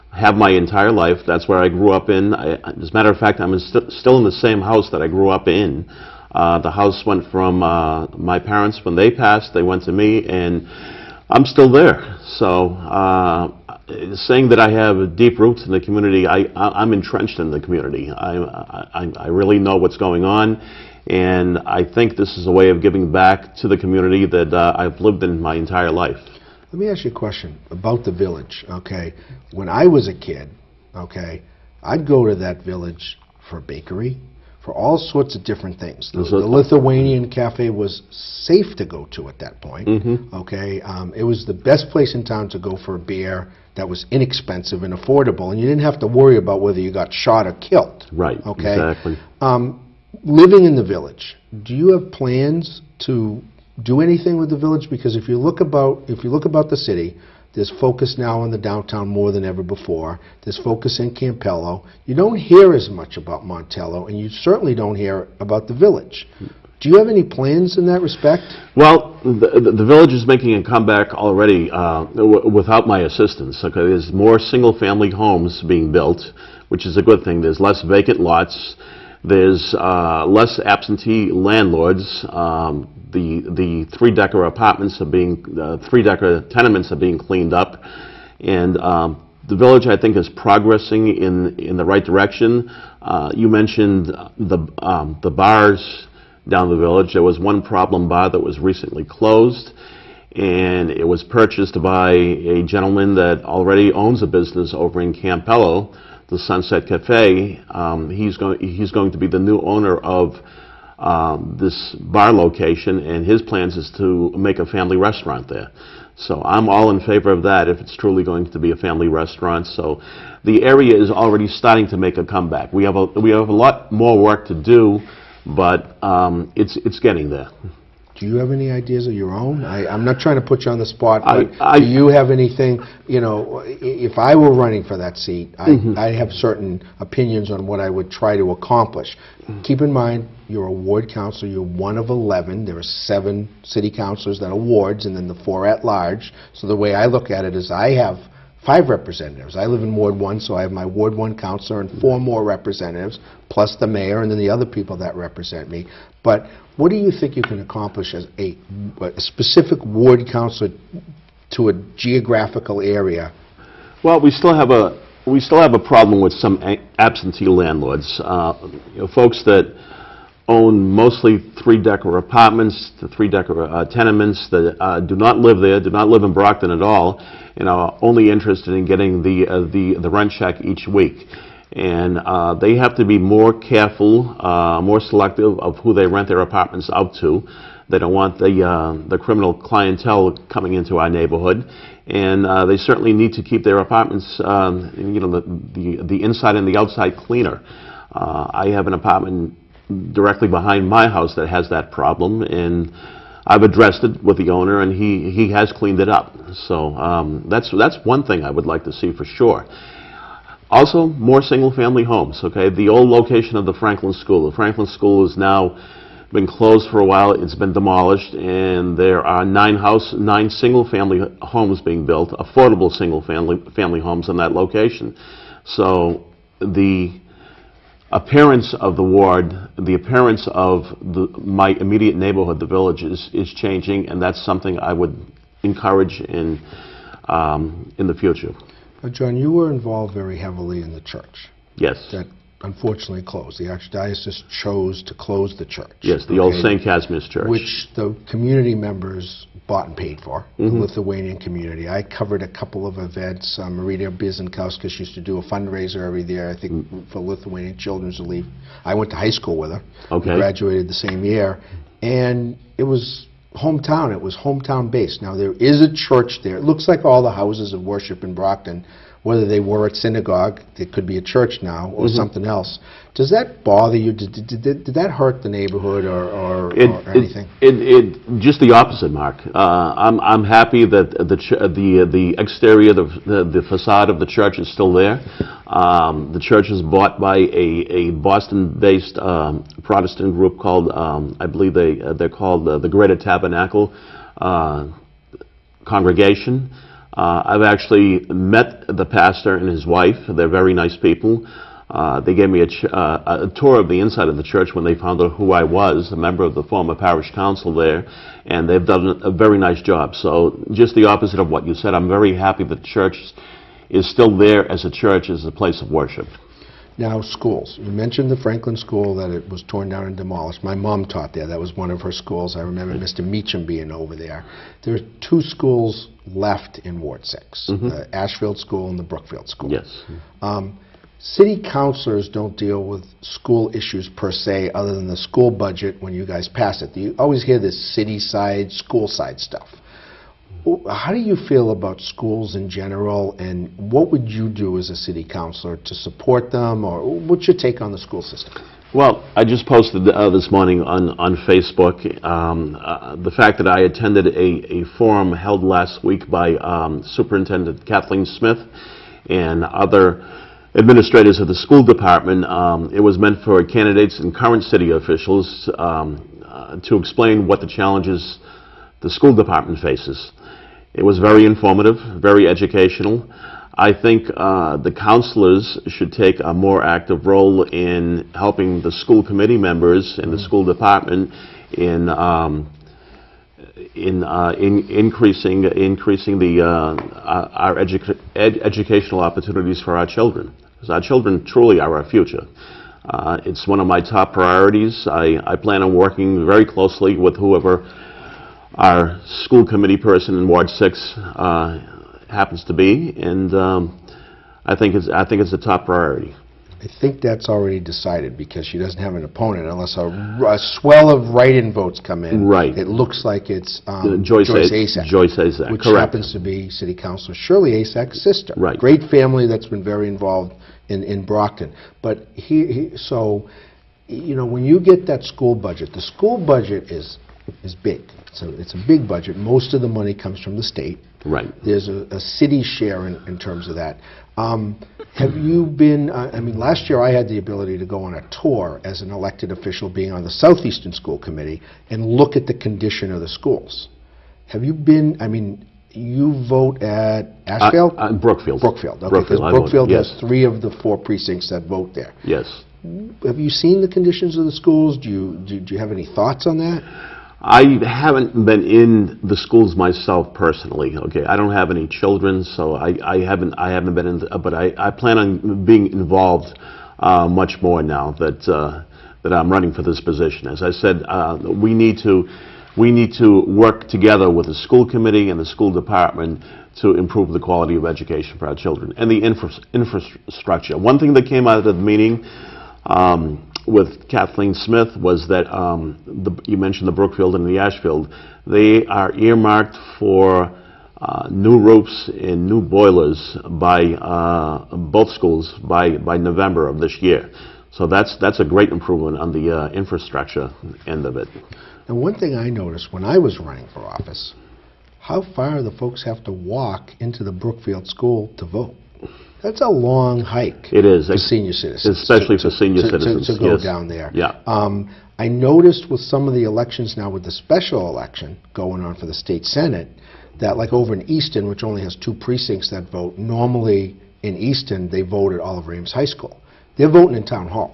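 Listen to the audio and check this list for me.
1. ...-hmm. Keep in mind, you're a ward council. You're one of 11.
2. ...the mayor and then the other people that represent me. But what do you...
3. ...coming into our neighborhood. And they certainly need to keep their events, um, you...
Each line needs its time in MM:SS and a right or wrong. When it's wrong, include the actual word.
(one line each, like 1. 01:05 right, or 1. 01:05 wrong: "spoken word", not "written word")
1. 02:19 right
2. 02:33 right
3. 03:10 wrong: "apartments", not "events".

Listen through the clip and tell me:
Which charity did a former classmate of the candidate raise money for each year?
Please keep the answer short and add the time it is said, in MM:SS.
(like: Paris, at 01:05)
Lithuanian Children's Relief, at 04:17.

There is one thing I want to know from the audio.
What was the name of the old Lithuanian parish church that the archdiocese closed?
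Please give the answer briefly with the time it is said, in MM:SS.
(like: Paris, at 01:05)
St. Casimir Church, at 04:06.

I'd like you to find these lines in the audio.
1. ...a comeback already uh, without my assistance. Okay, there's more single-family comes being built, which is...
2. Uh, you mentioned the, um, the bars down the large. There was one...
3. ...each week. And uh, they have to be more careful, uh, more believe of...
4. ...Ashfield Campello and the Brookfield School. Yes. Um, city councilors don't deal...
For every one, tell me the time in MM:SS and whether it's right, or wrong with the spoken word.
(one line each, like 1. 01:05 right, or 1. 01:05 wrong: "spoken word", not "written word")
1. 01:10 wrong: "homes", not "comes"
2. 01:33 wrong: "village", not "large"
3. 03:00 wrong: "selective", not "believe"
4. 05:28 wrong: "School", not "Campello".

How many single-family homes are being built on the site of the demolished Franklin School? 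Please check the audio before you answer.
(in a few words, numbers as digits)
9.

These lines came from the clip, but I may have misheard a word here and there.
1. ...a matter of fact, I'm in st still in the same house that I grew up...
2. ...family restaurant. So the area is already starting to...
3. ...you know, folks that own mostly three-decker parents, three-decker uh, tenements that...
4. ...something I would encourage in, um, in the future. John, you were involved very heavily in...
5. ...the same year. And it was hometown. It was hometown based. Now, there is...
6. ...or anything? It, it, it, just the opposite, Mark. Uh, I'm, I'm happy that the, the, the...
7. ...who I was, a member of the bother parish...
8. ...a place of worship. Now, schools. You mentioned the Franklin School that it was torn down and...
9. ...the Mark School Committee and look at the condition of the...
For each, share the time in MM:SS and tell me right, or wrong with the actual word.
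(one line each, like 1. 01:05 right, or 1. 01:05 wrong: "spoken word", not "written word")
1. 00:02 right
2. 01:58 right
3. 02:48 wrong: "apartments", not "parents"
4. 03:54 right
5. 04:20 right
6. 04:36 right
7. 05:05 wrong: "former", not "bother"
8. 05:15 right
9. 07:20 wrong: "Southeastern", not "Mark".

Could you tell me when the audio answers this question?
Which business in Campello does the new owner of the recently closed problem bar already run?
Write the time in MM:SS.
01:46.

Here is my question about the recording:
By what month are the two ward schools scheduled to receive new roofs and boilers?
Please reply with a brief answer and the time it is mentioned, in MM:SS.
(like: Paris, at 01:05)
November, at 08:16.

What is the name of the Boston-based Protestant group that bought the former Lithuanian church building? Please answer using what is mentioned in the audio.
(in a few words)
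Greater Tabernacle.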